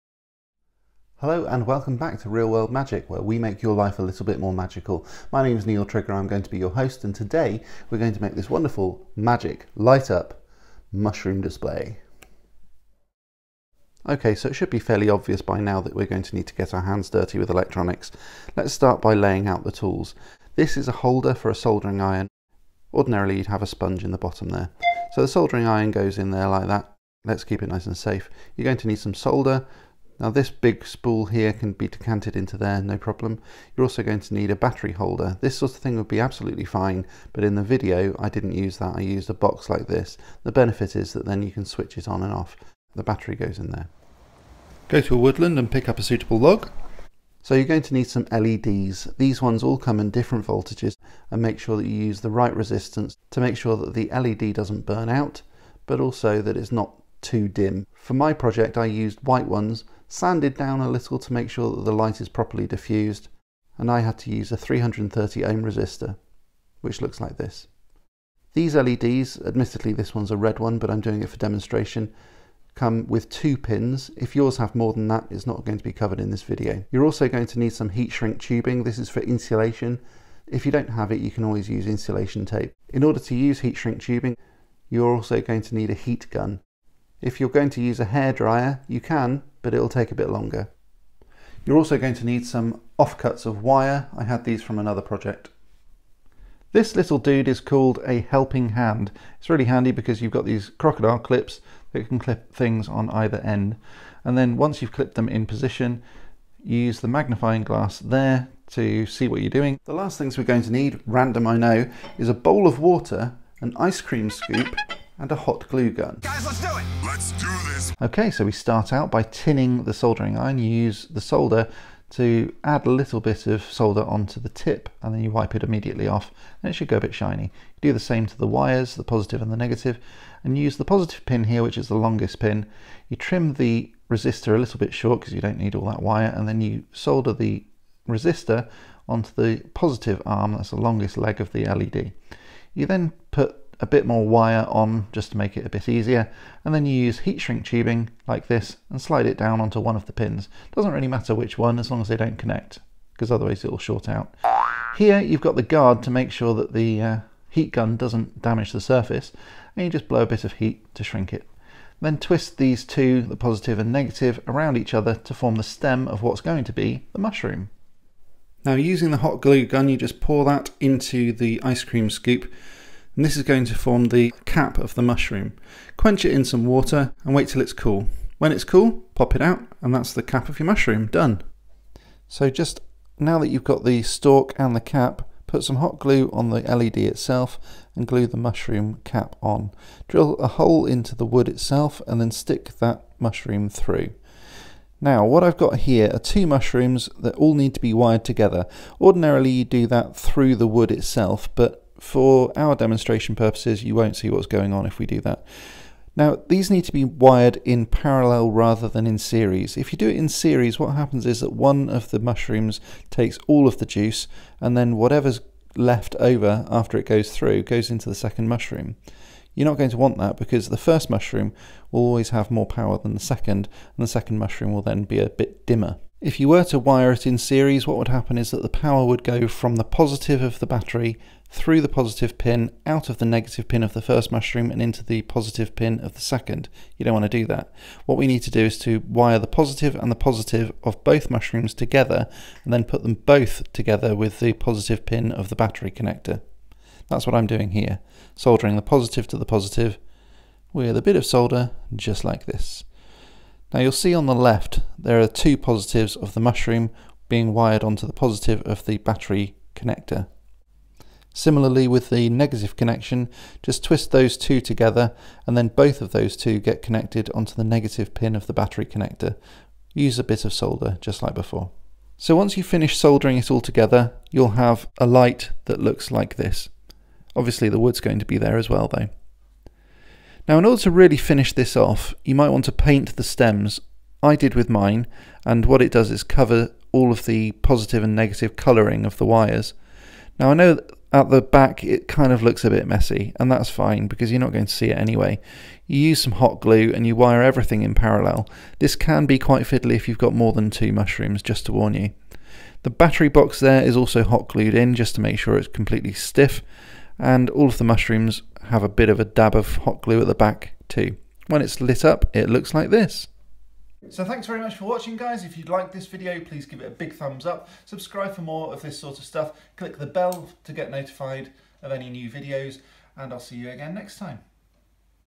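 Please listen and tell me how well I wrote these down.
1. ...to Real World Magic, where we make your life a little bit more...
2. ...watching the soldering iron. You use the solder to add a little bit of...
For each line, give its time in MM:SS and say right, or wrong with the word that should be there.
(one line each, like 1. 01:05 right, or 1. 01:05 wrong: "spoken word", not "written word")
1. 00:02 right
2. 01:59 wrong: "tinning", not "watching".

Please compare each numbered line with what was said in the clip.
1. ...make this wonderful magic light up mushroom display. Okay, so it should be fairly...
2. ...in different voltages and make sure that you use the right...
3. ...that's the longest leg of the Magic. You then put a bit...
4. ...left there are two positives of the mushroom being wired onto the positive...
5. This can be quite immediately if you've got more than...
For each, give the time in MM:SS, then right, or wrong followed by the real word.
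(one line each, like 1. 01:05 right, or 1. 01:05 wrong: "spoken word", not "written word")
1. 00:08 right
2. 00:49 right
3. 02:20 wrong: "LED", not "Magic"
4. 04:14 right
5. 04:58 wrong: "fiddly", not "immediately".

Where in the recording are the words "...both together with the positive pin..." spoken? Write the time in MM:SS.
04:03.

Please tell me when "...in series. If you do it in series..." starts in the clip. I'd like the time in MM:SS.
03:29.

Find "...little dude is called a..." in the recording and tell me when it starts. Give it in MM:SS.
01:36.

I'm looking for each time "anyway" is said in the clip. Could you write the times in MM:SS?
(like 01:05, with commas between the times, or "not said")
04:54.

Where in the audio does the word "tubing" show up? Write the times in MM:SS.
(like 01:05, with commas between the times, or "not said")
01:18, 01:24, 02:27.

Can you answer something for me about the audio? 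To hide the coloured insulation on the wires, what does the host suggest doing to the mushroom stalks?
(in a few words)
paint the stems.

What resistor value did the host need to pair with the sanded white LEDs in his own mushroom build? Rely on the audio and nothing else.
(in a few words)
330 ohm.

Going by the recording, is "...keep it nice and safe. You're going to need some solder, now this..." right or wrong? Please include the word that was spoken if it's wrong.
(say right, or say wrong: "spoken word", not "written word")
right.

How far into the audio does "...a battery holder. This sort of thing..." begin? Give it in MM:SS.
00:34.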